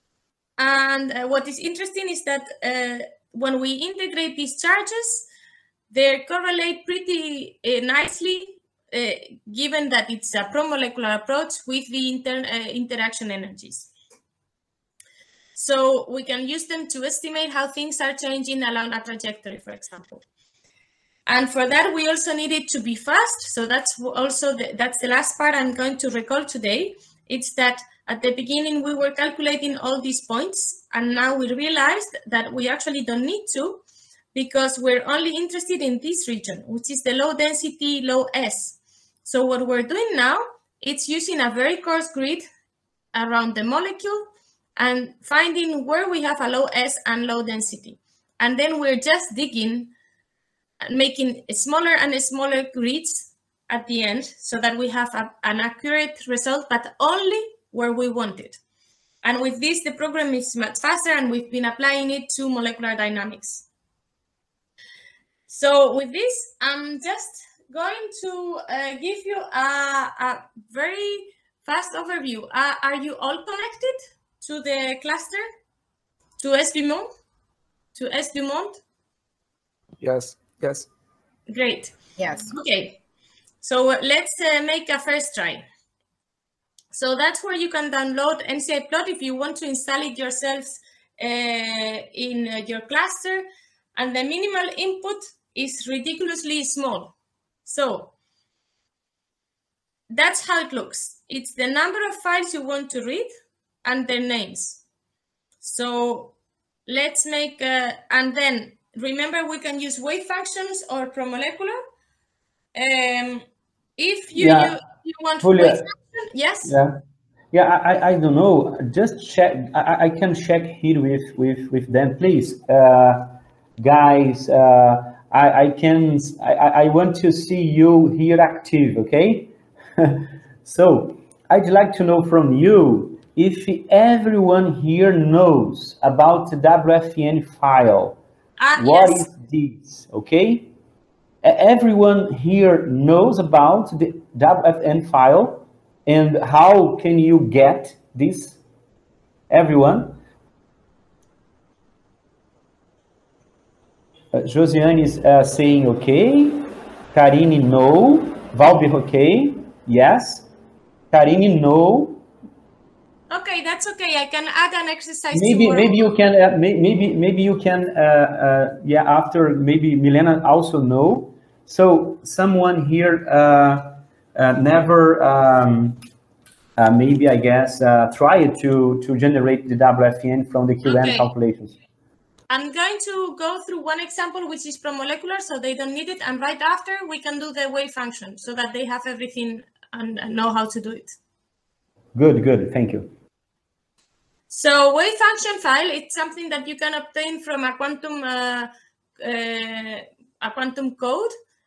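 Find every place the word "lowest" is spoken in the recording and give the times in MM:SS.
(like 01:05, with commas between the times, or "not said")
not said.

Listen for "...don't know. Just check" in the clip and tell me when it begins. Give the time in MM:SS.
01:58.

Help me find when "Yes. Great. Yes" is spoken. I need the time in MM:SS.
01:20.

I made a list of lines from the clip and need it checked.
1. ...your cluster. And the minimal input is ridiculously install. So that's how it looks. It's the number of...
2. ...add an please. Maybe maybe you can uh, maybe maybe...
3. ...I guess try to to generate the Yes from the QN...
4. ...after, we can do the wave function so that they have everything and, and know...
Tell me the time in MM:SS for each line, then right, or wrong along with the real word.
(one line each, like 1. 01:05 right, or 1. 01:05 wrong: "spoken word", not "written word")
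1. 01:32 wrong: "small", not "install"
2. 02:44 wrong: "exercise", not "please"
3. 02:57 wrong: "WFN", not "Yes"
4. 03:06 right.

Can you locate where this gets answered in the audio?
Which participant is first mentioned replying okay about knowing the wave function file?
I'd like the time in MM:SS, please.
02:34.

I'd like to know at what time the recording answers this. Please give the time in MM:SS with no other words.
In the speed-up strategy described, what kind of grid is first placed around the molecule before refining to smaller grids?
00:41.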